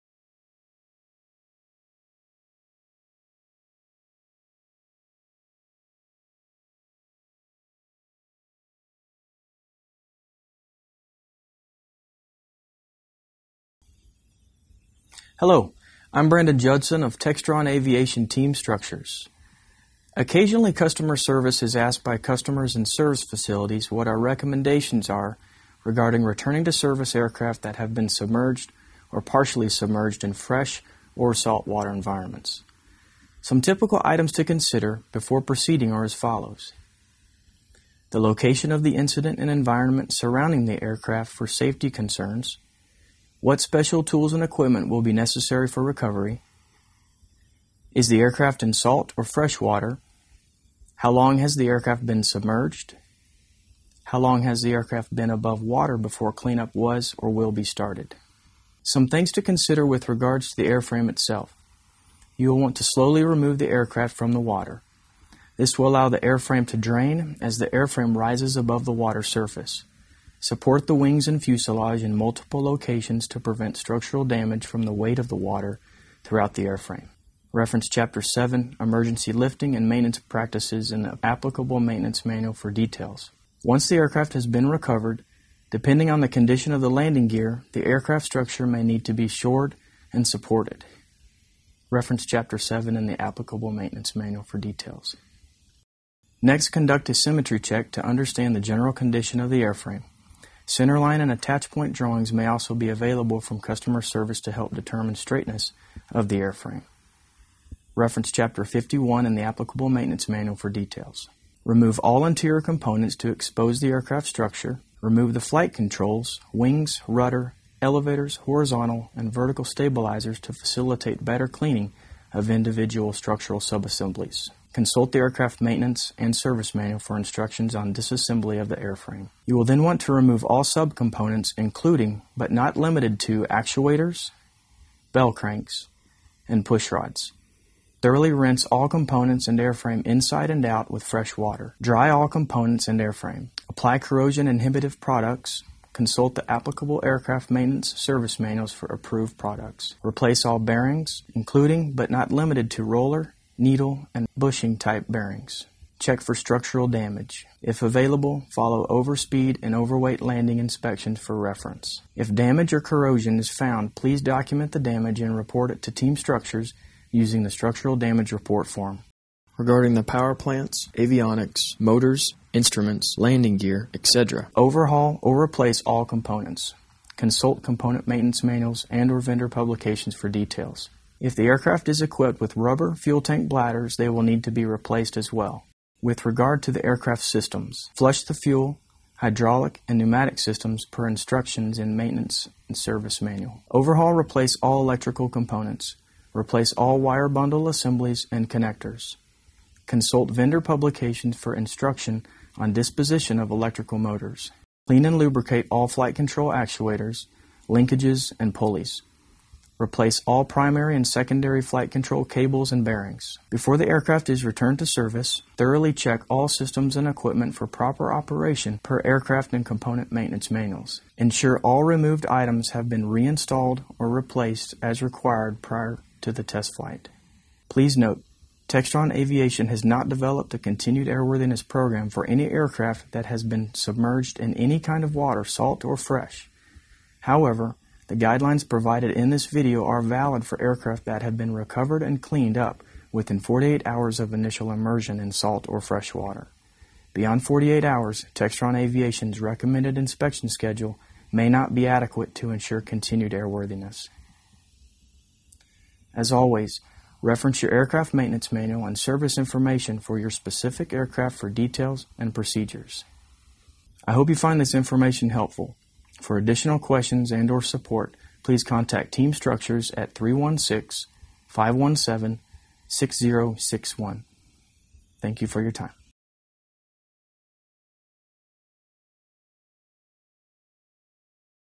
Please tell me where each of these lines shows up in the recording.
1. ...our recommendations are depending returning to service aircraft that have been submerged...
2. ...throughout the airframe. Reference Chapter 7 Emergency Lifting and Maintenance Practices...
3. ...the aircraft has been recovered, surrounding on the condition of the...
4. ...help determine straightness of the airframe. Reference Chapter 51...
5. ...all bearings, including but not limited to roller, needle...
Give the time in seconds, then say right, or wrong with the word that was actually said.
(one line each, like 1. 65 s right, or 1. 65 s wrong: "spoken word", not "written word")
1. 24 s wrong: "regarding", not "depending"
2. 76 s right
3. 83 s wrong: "depending", not "surrounding"
4. 104 s right
5. 150 s right.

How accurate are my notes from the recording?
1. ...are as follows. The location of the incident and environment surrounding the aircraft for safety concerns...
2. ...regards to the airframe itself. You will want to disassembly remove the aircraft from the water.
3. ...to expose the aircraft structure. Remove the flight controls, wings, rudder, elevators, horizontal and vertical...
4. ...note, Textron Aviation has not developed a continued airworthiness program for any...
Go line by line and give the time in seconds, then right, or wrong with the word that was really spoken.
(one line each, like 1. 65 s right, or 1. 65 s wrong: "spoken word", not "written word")
1. 35 s right
2. 60 s wrong: "slowly", not "disassembly"
3. 113 s right
4. 227 s right.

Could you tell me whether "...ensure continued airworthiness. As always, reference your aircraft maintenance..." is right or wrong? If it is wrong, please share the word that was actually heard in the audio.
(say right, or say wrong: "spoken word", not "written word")
right.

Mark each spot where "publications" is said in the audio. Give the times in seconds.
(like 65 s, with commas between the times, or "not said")
179 s, 200 s.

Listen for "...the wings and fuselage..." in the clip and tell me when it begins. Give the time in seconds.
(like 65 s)
70 s.